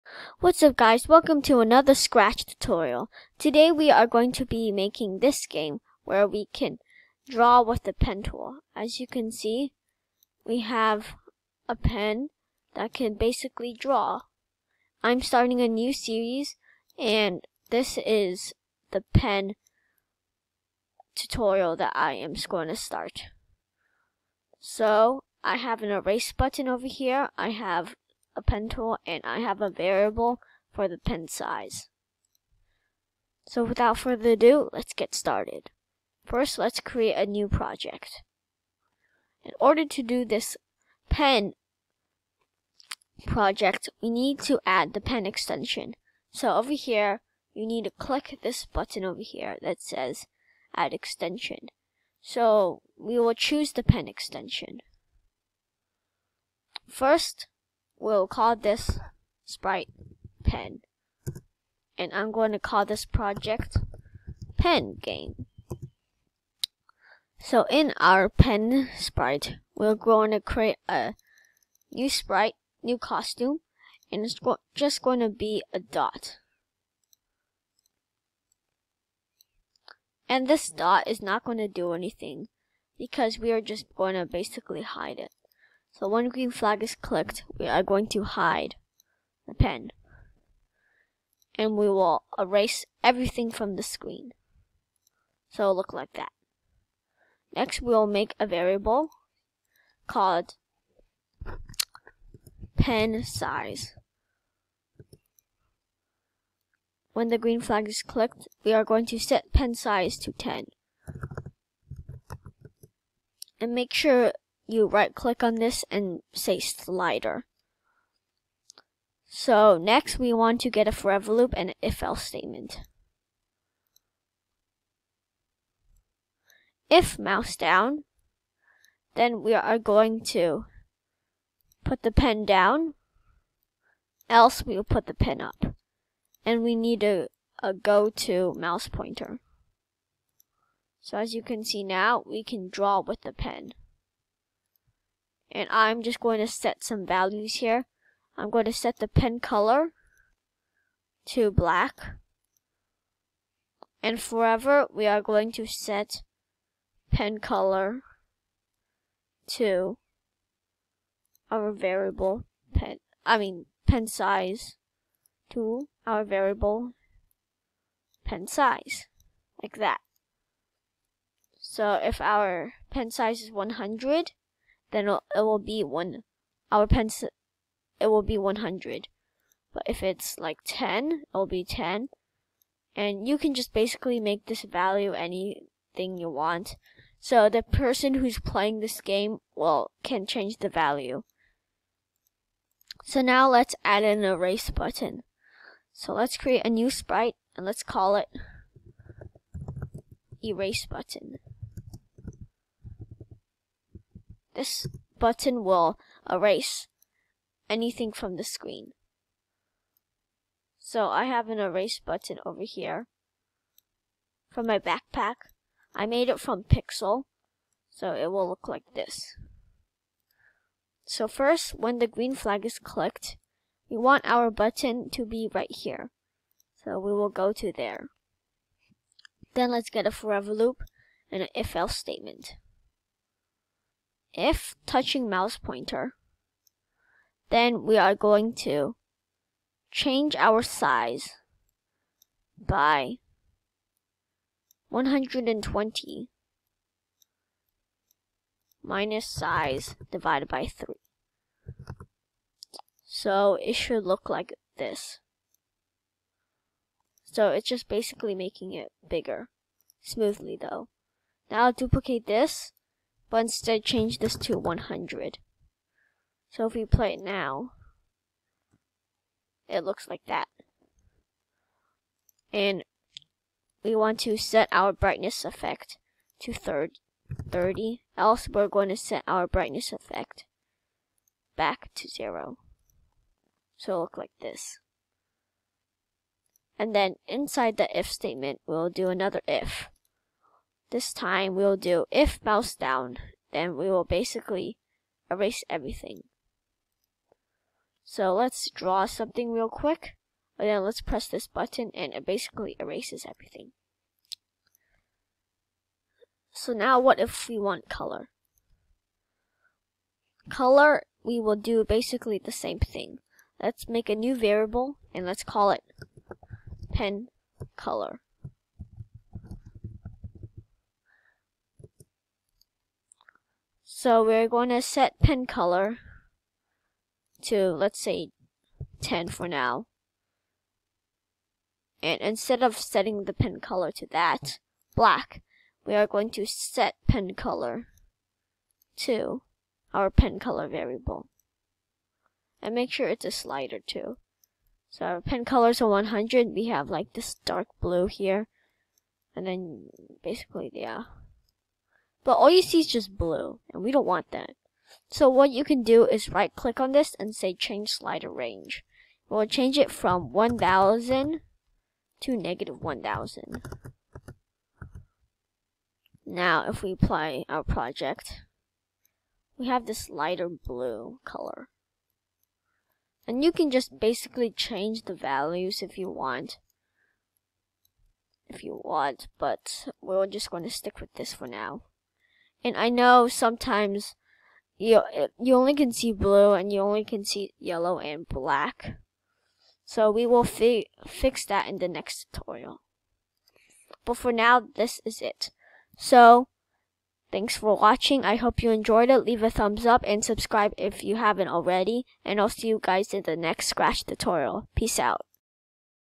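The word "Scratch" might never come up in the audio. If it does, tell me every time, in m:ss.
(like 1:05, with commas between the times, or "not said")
0:01, 6:43.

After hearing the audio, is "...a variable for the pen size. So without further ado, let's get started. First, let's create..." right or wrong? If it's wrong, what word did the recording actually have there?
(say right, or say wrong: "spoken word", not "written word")
right.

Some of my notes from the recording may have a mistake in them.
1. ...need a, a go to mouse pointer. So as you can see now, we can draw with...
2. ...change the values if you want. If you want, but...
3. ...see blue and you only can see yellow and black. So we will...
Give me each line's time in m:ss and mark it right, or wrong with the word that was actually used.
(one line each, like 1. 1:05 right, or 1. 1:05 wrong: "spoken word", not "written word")
1. 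2:16 right
2. 6:14 right
3. 6:25 right.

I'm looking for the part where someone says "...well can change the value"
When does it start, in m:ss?
3:09.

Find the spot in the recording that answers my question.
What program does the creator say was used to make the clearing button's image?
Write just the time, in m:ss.
3:36.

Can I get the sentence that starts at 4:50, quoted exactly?
This time we'll do if mouse down, then we will basically erase everything.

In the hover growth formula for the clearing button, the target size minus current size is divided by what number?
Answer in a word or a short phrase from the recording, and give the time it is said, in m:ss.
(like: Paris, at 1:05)
3, at 4:10.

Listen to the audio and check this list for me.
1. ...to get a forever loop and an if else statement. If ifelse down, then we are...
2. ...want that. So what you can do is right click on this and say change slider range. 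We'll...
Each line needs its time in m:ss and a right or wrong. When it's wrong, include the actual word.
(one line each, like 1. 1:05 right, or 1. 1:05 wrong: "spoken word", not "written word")
1. 2:00 wrong: "mouse", not "ifelse"
2. 5:54 right.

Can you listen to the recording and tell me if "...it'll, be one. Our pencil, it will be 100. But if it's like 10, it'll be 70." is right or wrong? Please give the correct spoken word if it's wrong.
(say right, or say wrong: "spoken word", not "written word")
wrong: "10", not "70".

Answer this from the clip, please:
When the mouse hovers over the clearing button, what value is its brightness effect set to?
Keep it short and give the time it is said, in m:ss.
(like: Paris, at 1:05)
30, at 4:34.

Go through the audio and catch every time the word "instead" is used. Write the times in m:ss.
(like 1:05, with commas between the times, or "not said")
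4:23, 5:32.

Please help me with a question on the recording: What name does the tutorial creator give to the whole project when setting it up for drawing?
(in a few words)
pen game.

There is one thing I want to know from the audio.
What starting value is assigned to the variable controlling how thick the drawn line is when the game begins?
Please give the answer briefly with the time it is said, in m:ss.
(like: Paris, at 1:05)
10, at 1:49.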